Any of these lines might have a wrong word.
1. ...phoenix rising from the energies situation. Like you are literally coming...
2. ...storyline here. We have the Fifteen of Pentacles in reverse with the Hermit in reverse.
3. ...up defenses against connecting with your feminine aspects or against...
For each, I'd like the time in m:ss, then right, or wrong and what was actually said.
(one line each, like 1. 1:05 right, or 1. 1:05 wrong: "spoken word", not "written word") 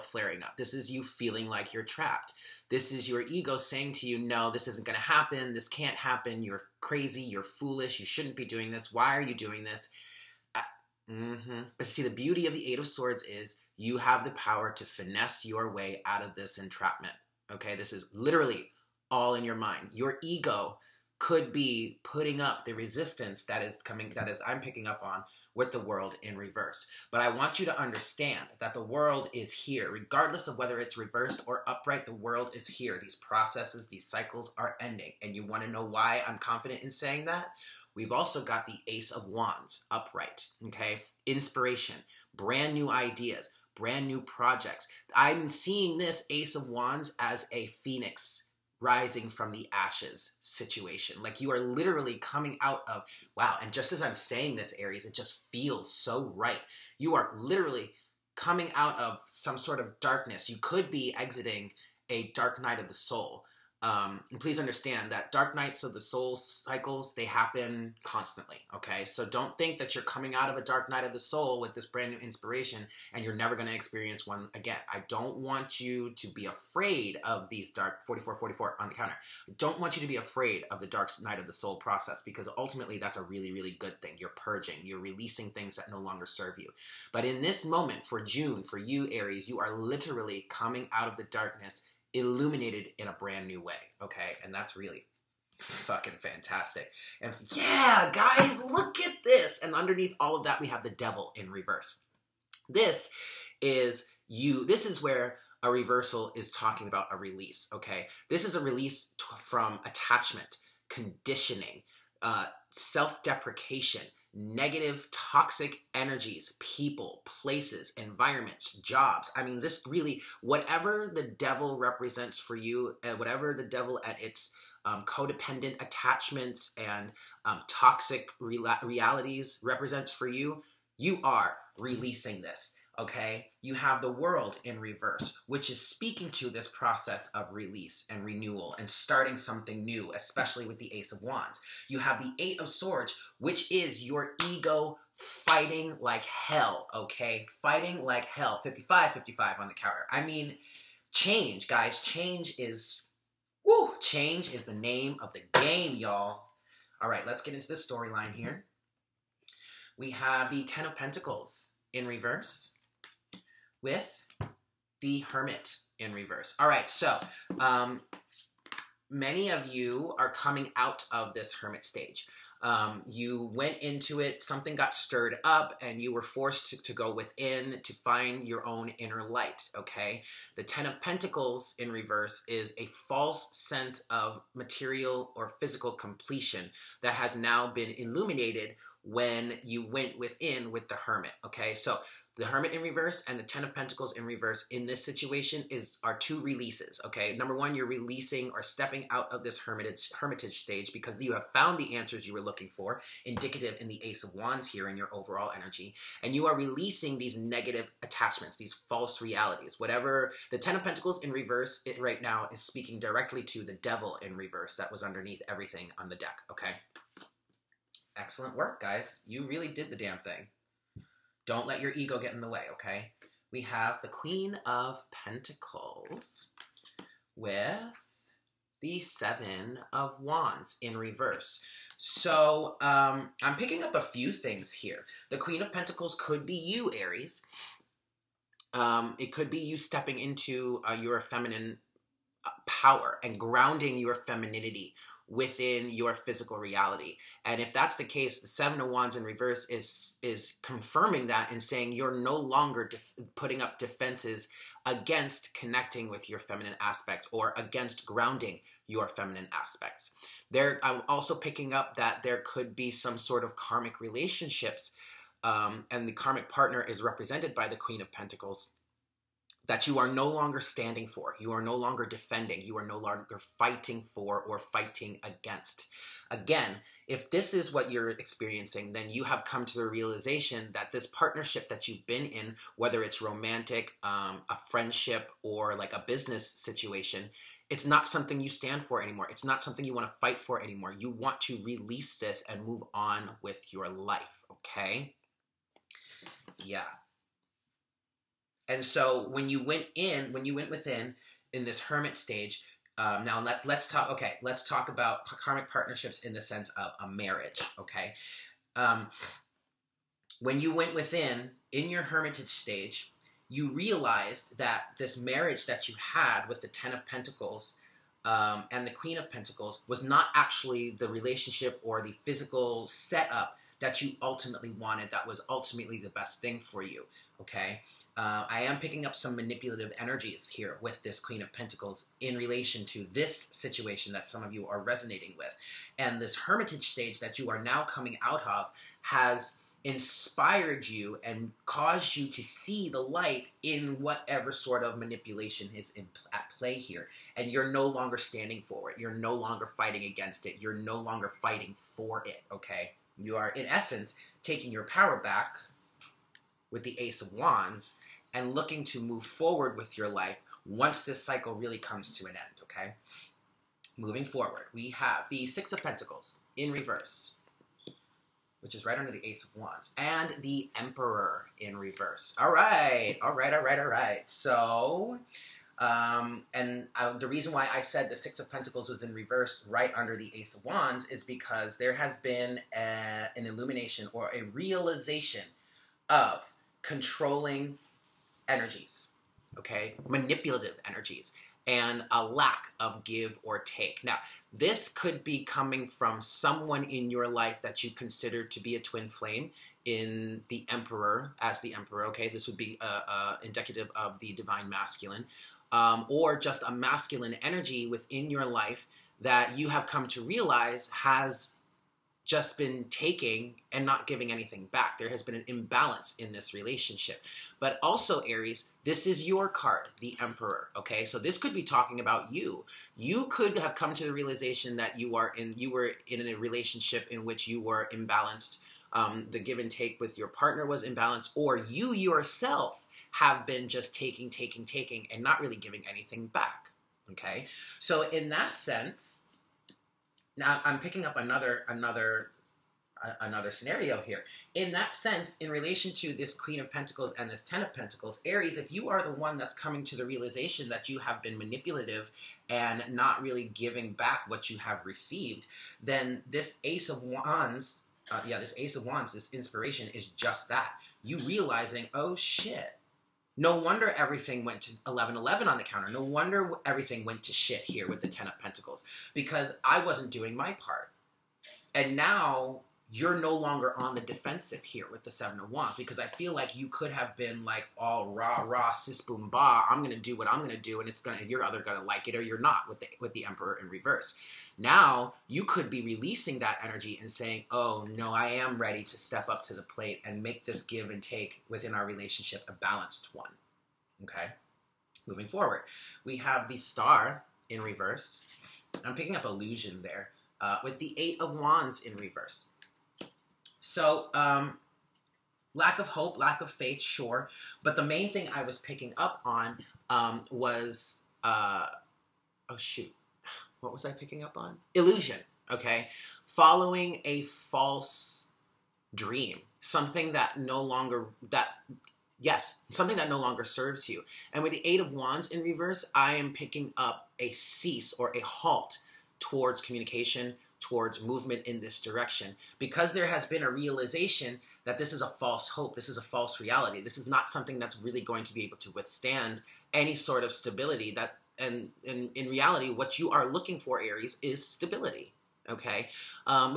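1. 0:47 wrong: "ashes", not "energies"
2. 2:37 wrong: "Ten", not "Fifteen"
3. 4:13 right.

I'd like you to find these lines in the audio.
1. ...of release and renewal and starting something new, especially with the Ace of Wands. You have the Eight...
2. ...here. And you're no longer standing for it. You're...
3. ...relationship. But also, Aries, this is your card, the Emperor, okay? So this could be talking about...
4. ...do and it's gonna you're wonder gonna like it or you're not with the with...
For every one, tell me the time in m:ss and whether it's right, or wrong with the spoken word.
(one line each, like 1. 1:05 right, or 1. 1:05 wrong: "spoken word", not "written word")
1. 2:17 right
2. 5:46 right
3. 6:56 right
4. 8:00 wrong: "either", not "wonder".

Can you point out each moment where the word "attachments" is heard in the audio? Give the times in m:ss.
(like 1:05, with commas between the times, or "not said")
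1:49, 2:05, 3:28.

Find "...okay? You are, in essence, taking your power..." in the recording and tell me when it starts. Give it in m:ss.
5:52.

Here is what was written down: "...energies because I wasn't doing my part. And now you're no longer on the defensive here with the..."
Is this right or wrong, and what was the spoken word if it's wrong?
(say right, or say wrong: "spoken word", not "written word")
wrong: "pentacles", not "energies".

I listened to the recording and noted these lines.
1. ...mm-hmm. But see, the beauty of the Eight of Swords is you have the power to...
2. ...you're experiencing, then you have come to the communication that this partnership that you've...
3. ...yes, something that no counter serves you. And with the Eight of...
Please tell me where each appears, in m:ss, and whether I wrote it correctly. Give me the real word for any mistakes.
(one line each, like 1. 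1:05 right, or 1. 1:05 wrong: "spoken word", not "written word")
1. 0:11 right
2. 4:37 wrong: "realization", not "communication"
3. 8:42 wrong: "longer", not "counter".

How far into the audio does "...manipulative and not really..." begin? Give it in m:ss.
7:31.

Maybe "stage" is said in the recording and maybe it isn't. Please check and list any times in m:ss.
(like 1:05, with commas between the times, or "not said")
2:51, 3:20, 5:02, 5:12, 5:36.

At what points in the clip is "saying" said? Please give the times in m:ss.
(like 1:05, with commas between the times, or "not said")
0:03, 0:36, 0:54, 4:11, 8:07.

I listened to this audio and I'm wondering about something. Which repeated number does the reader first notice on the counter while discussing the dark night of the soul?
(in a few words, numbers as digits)
44.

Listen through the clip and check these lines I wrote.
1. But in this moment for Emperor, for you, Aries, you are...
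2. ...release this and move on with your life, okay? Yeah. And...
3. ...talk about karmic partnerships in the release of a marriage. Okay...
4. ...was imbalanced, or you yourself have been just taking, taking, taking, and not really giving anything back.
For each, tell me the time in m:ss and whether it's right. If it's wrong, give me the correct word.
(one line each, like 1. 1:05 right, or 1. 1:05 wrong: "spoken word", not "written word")
1. 1:27 wrong: "June", not "Emperor"
2. 4:51 right
3. 5:04 wrong: "sense", not "release"
4. 7:10 right.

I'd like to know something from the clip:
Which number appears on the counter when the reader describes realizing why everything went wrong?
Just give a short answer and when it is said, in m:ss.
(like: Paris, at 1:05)
1111, at 7:44.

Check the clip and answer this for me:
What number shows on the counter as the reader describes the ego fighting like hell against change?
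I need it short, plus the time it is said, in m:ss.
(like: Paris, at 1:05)
55, at 2:28.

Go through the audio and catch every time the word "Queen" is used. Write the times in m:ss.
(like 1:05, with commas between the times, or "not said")
3:44, 3:55, 4:27, 5:18, 5:31, 7:26.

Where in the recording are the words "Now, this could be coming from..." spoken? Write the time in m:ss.
6:34.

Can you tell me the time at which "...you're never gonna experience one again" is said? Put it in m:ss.
1:13.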